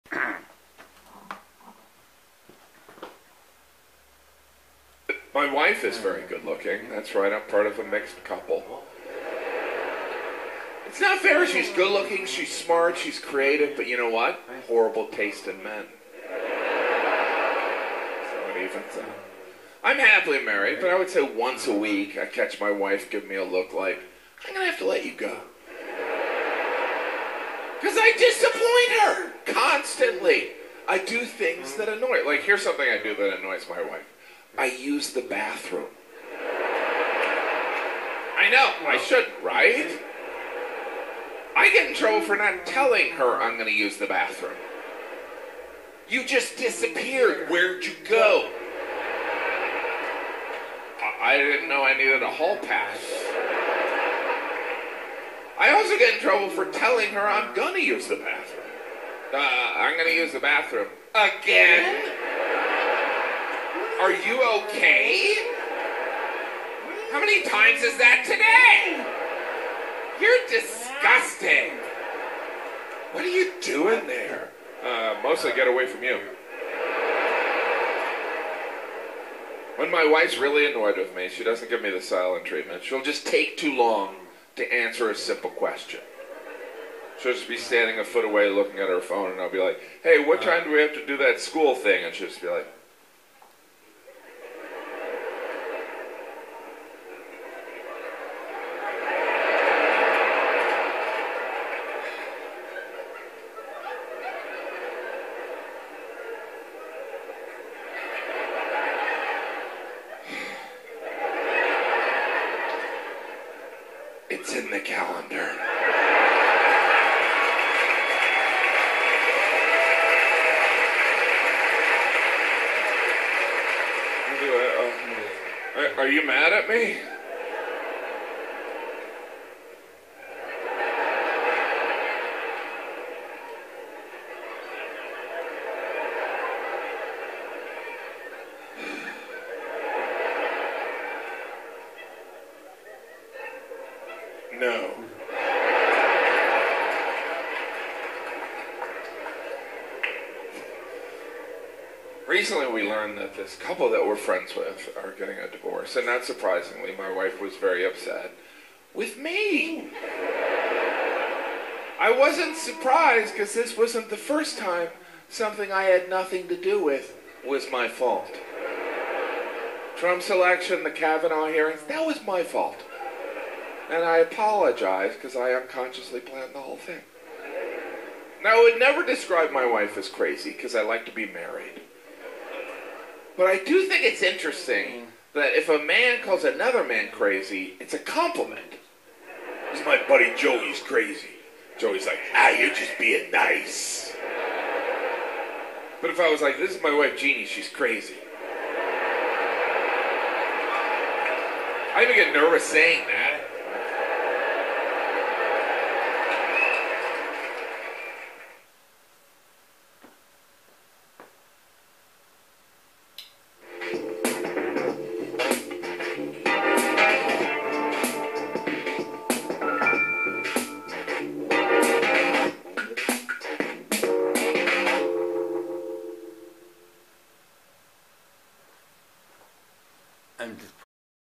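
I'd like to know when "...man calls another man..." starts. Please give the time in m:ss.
3:05.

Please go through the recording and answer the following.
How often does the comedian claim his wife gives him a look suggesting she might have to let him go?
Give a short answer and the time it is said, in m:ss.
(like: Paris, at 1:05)
Once a week, at 0:21.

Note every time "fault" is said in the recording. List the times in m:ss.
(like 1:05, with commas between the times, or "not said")
2:47, 2:52.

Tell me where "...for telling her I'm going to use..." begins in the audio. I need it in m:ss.
0:56.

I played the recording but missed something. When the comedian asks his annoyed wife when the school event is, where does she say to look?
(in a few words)
The calendar.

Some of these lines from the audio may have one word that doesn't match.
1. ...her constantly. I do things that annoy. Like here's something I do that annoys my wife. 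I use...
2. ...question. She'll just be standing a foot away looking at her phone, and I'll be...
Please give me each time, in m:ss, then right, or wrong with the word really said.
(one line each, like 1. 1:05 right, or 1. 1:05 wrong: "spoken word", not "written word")
1. 0:29 right
2. 1:25 right.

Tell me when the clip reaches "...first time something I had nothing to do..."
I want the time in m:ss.
2:44.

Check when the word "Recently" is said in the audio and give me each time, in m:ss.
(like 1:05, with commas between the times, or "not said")
2:32.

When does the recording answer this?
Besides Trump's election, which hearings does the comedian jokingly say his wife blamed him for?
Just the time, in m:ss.
2:50.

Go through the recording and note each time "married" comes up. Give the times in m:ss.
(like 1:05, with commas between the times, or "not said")
0:20, 3:01.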